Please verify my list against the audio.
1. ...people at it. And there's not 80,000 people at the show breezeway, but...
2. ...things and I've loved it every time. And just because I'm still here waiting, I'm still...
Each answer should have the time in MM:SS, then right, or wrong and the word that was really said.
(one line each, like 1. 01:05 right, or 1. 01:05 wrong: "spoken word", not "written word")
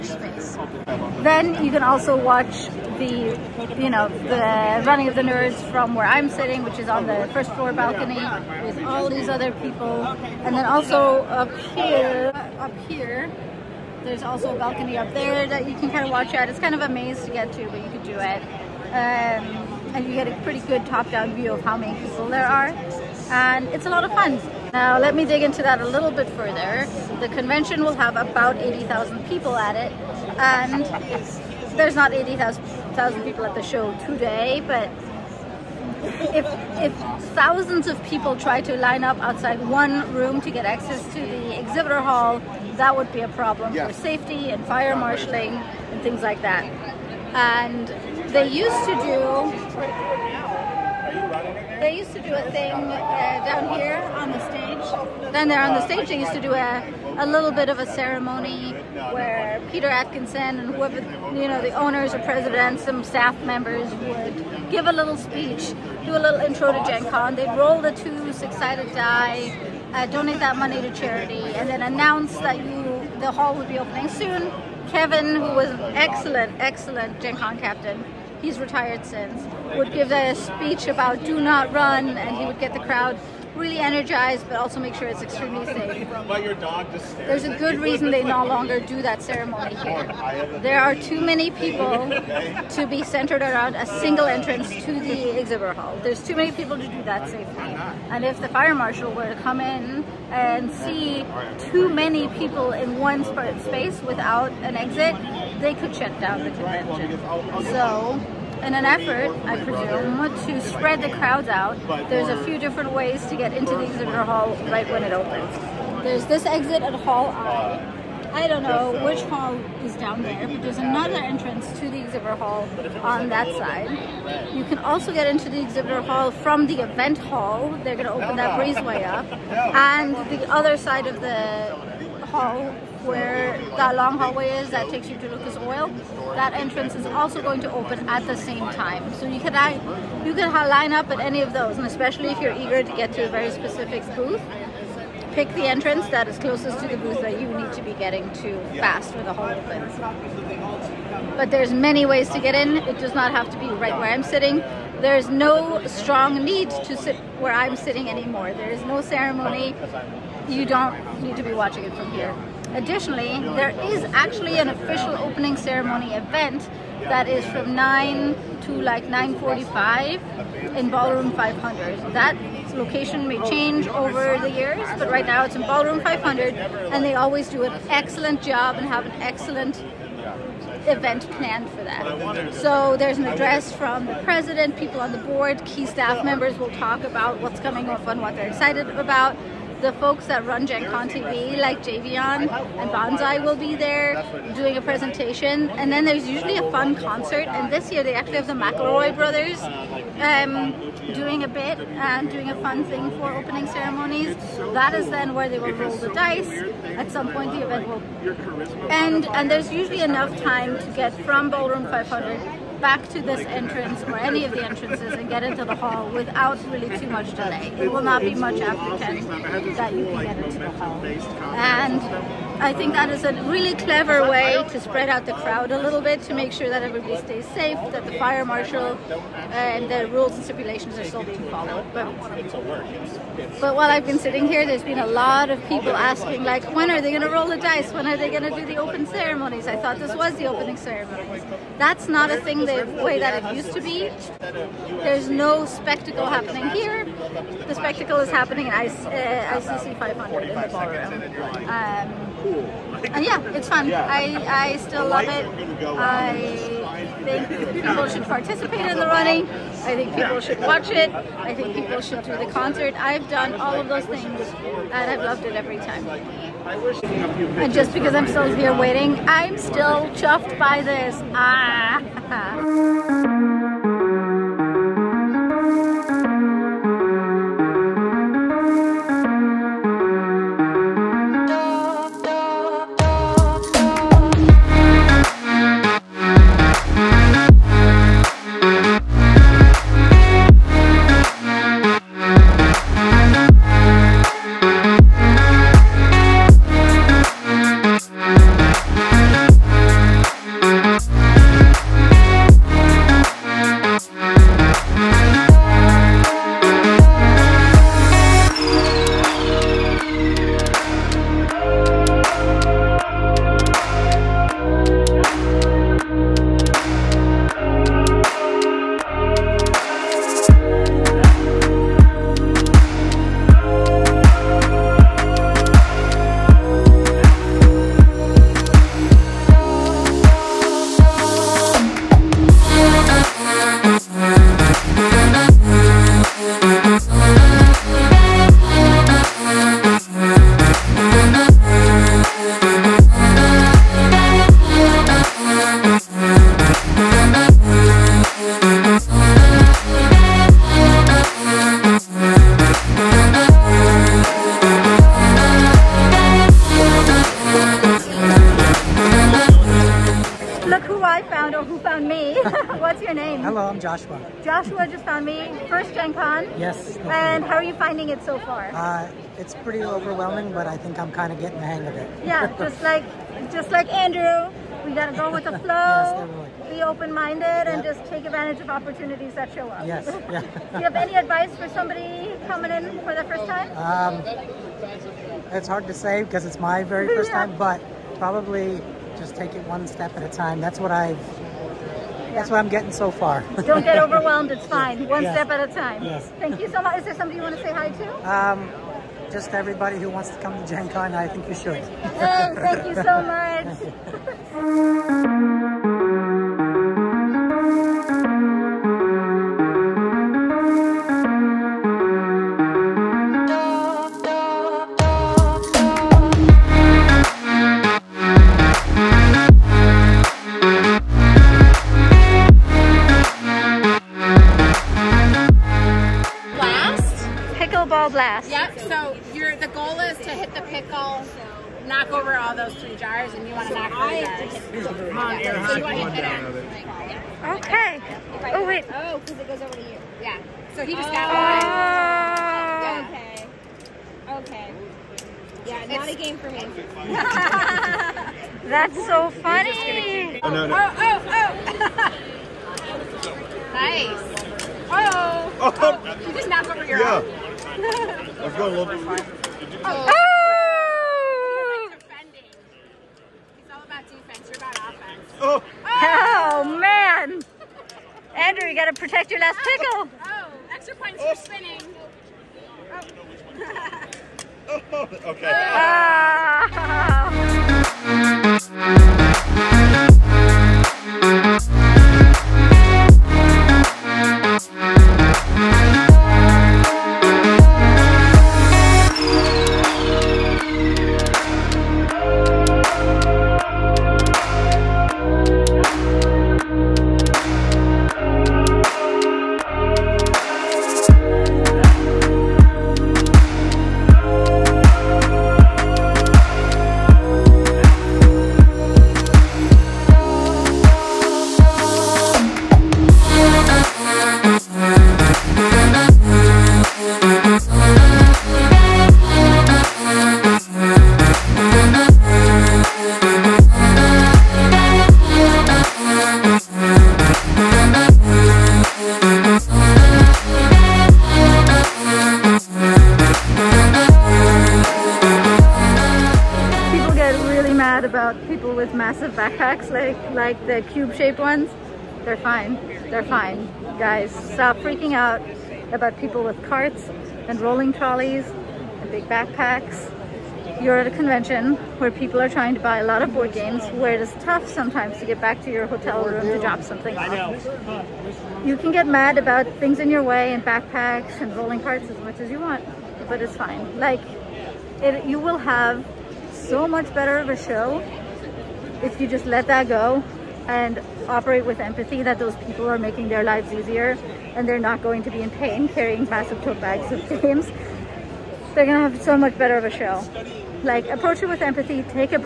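1. 00:29 wrong: "today", not "breezeway"
2. 04:24 right.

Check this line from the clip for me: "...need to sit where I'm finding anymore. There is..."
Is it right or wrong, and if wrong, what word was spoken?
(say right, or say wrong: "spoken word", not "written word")
wrong: "sitting", not "finding".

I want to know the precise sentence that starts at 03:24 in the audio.
That is then where they will roll the dice.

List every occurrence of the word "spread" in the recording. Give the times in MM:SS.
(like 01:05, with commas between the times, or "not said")
01:50, 03:44.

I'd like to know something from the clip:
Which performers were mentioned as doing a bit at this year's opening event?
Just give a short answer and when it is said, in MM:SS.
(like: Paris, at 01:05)
The McElroy brothers, at 03:18.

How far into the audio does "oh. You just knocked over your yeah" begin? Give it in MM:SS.
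07:36.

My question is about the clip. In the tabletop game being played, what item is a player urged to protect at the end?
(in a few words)
Last pickle.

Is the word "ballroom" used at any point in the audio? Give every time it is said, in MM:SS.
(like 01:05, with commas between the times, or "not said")
02:50, 02:55, 03:31, 04:10.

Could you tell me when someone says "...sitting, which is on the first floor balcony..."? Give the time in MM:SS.
00:06.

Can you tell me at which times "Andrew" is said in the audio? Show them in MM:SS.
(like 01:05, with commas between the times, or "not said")
06:13.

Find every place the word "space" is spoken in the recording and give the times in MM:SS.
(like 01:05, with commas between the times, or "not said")
00:00, 01:43.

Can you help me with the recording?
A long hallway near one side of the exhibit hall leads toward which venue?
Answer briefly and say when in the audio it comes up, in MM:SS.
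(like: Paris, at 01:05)
Lucas Oil, at 02:15.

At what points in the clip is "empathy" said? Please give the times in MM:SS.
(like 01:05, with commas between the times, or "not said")
09:31, 09:41.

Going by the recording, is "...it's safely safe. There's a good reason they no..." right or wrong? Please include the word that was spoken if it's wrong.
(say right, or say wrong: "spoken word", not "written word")
wrong: "extremely", not "safely".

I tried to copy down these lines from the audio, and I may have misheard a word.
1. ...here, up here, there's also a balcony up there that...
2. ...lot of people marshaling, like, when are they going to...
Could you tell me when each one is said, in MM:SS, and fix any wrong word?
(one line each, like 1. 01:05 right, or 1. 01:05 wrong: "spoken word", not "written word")
1. 00:11 right
2. 03:55 wrong: "asking", not "marshaling".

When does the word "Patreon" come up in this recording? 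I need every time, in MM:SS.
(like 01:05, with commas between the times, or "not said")
not said.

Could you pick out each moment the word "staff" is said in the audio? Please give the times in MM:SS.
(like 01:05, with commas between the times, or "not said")
01:03, 03:05.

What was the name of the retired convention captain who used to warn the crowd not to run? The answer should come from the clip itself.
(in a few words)
Kevin.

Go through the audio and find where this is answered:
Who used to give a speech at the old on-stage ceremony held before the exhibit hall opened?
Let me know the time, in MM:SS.
00:59.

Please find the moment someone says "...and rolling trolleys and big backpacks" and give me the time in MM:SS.
09:07.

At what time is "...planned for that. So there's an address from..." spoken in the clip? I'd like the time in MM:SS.
03:01.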